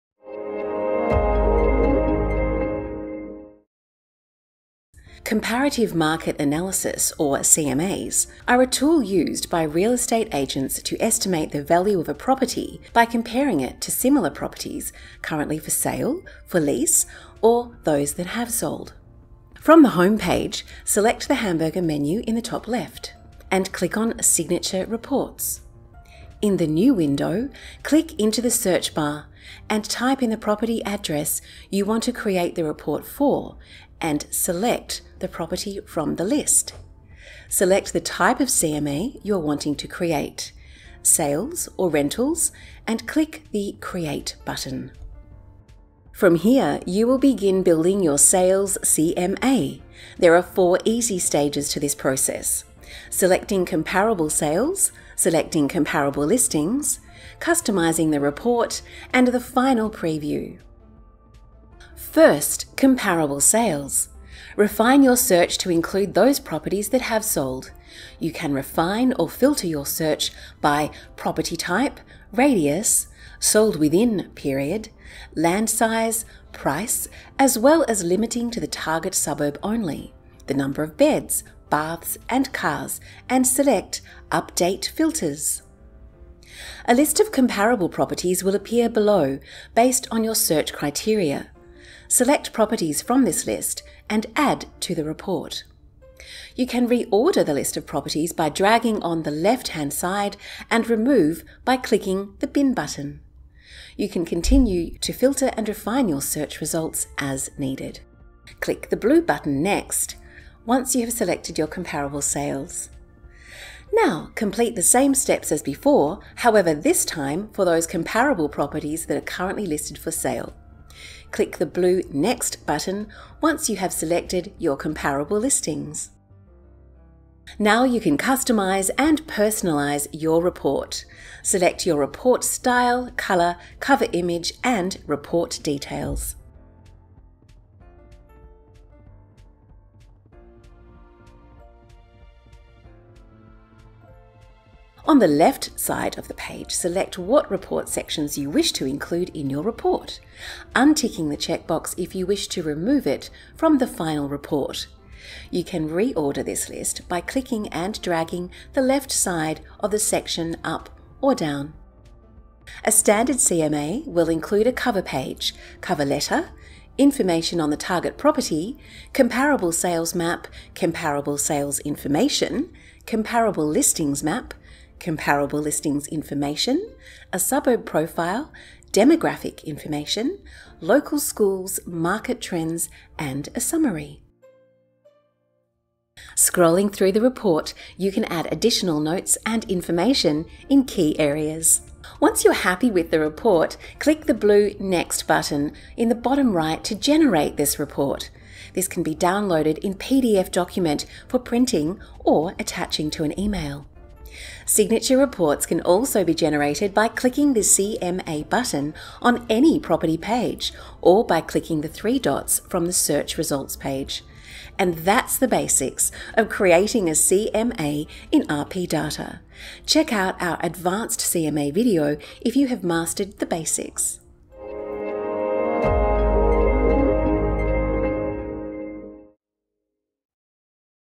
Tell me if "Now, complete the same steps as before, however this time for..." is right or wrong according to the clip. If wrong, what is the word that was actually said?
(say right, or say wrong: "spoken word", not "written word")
right.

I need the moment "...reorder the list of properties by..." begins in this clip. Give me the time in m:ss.
1:36.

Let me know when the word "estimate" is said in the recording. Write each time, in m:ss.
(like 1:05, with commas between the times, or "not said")
0:11.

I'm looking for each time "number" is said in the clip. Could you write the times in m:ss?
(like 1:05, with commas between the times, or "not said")
1:20.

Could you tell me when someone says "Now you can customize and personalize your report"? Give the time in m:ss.
2:07.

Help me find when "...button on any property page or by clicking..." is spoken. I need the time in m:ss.
3:28.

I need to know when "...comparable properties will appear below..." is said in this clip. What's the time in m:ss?
1:27.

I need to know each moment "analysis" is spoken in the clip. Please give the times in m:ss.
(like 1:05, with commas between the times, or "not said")
0:06.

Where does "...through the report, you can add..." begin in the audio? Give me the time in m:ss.
3:06.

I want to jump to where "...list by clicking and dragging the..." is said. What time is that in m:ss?
2:36.